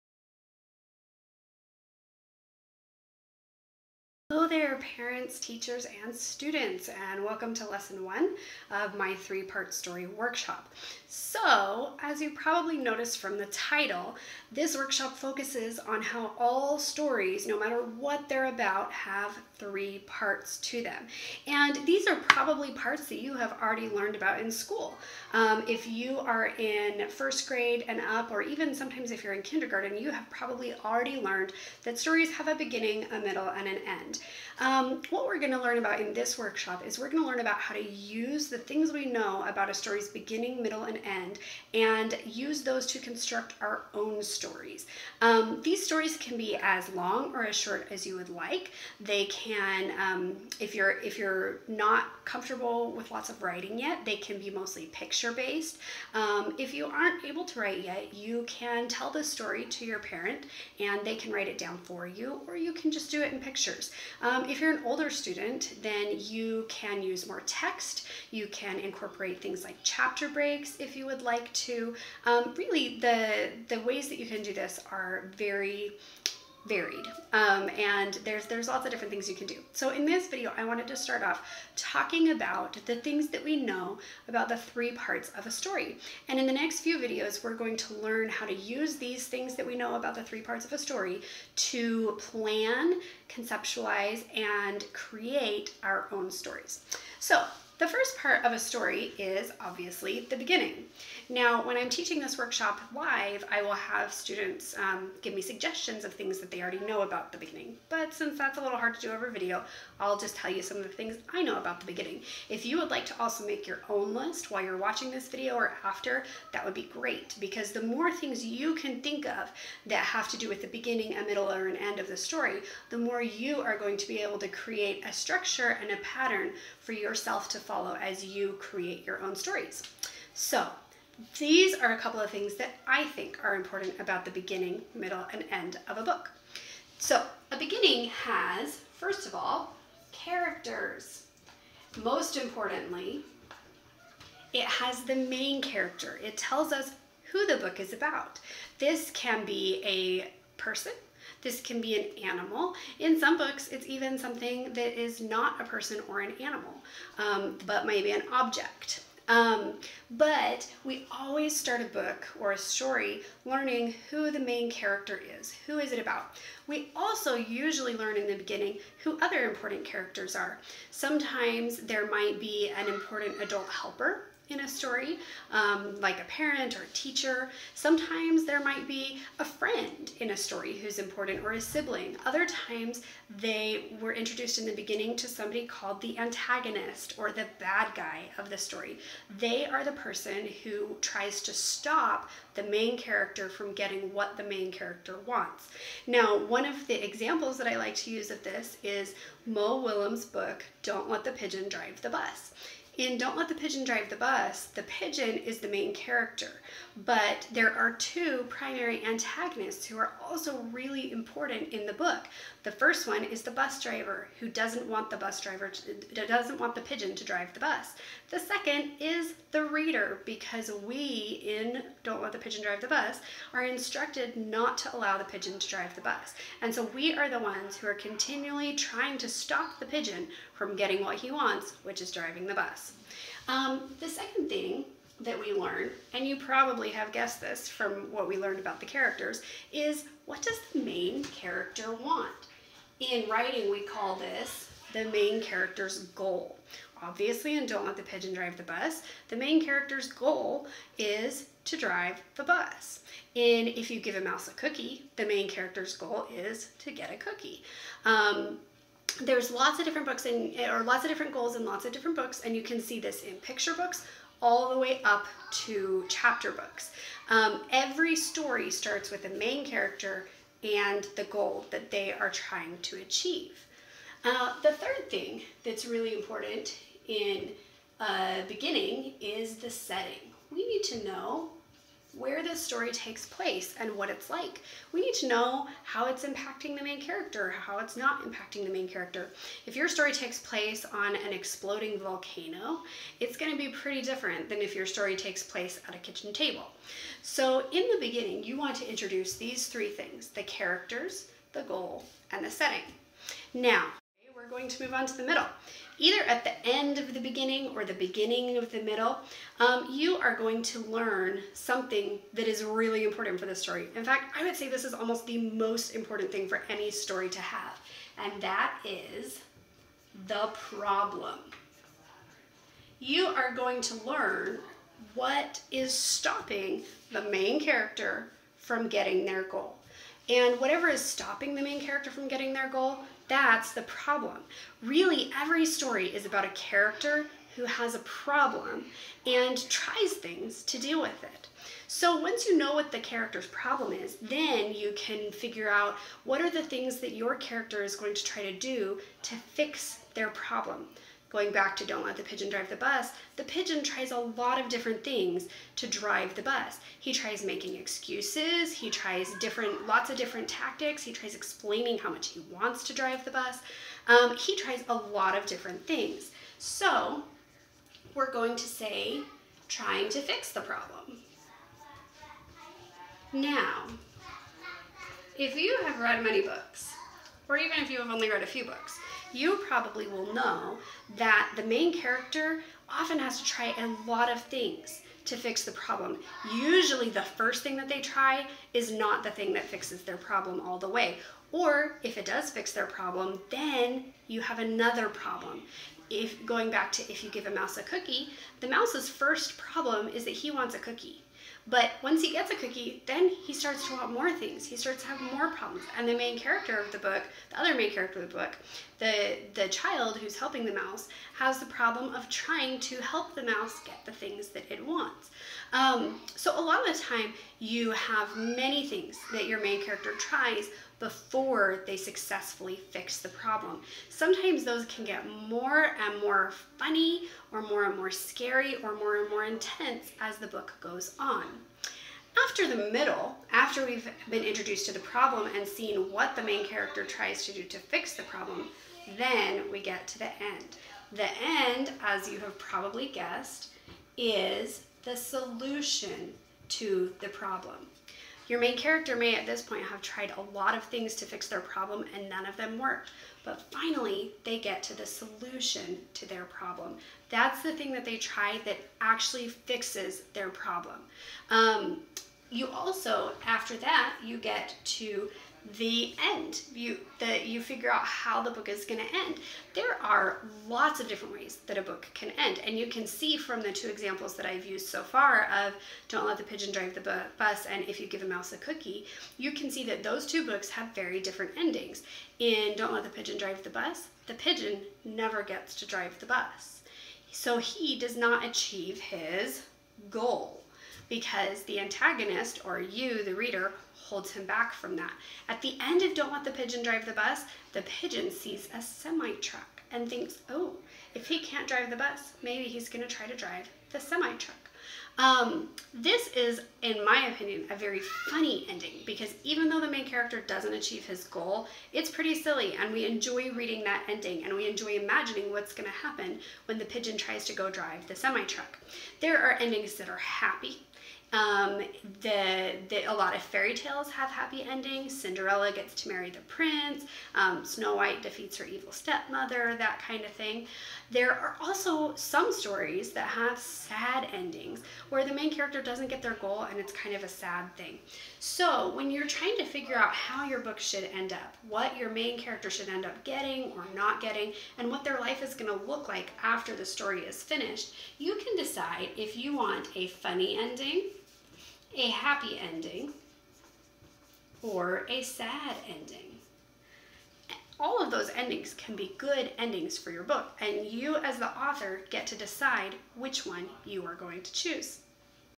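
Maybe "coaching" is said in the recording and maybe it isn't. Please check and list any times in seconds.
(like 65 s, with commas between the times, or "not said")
not said.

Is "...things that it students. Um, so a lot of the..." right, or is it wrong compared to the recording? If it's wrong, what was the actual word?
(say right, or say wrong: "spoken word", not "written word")
wrong: "wants", not "students".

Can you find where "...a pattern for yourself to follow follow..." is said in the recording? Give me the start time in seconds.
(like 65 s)
125 s.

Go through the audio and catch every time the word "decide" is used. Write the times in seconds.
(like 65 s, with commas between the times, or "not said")
548 s, 562 s.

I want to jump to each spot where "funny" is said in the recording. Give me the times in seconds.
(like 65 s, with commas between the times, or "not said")
426 s, 508 s, 550 s.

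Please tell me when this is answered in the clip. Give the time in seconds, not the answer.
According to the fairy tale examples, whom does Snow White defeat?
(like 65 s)
528 s.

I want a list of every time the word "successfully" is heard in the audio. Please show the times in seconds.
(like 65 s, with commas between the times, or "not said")
421 s.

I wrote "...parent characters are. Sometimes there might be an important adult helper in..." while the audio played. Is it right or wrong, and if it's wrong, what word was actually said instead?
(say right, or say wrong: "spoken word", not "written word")
wrong: "important", not "parent".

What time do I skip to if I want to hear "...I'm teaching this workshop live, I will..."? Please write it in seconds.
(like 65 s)
101 s.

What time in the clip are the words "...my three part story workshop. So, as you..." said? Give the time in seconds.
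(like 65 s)
8 s.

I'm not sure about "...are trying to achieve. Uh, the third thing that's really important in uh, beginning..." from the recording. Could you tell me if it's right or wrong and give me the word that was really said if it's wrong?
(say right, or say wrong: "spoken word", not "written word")
right.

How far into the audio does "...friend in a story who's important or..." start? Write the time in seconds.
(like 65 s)
179 s.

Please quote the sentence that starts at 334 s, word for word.
Really, every story is about a character who has a problem and tries things to deal with it.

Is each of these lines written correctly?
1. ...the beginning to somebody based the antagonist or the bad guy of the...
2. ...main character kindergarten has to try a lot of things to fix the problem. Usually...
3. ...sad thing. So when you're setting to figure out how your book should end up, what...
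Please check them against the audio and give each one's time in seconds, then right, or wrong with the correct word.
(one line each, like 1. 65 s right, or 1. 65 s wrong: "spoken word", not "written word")
1. 184 s wrong: "called", not "based"
2. 381 s wrong: "often", not "kindergarten"
3. 537 s wrong: "trying", not "setting".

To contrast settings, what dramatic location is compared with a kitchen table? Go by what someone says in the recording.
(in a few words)
An exploding volcano.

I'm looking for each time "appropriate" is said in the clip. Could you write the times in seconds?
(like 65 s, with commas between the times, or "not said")
not said.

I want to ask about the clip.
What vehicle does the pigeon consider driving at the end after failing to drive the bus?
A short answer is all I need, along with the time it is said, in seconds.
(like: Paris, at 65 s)
A semi truck, at 498 s.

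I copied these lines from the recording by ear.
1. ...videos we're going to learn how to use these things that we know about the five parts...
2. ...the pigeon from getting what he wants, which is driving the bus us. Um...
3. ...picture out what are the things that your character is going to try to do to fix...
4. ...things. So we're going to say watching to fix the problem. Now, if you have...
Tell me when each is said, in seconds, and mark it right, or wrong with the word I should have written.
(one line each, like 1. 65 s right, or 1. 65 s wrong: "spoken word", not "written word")
1. 86 s wrong: "three", not "five"
2. 229 s right
3. 345 s wrong: "figure", not "picture"
4. 365 s wrong: "trying", not "watching".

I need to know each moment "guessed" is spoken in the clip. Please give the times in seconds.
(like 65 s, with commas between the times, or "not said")
237 s, 443 s.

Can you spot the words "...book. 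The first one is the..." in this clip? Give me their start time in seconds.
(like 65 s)
211 s.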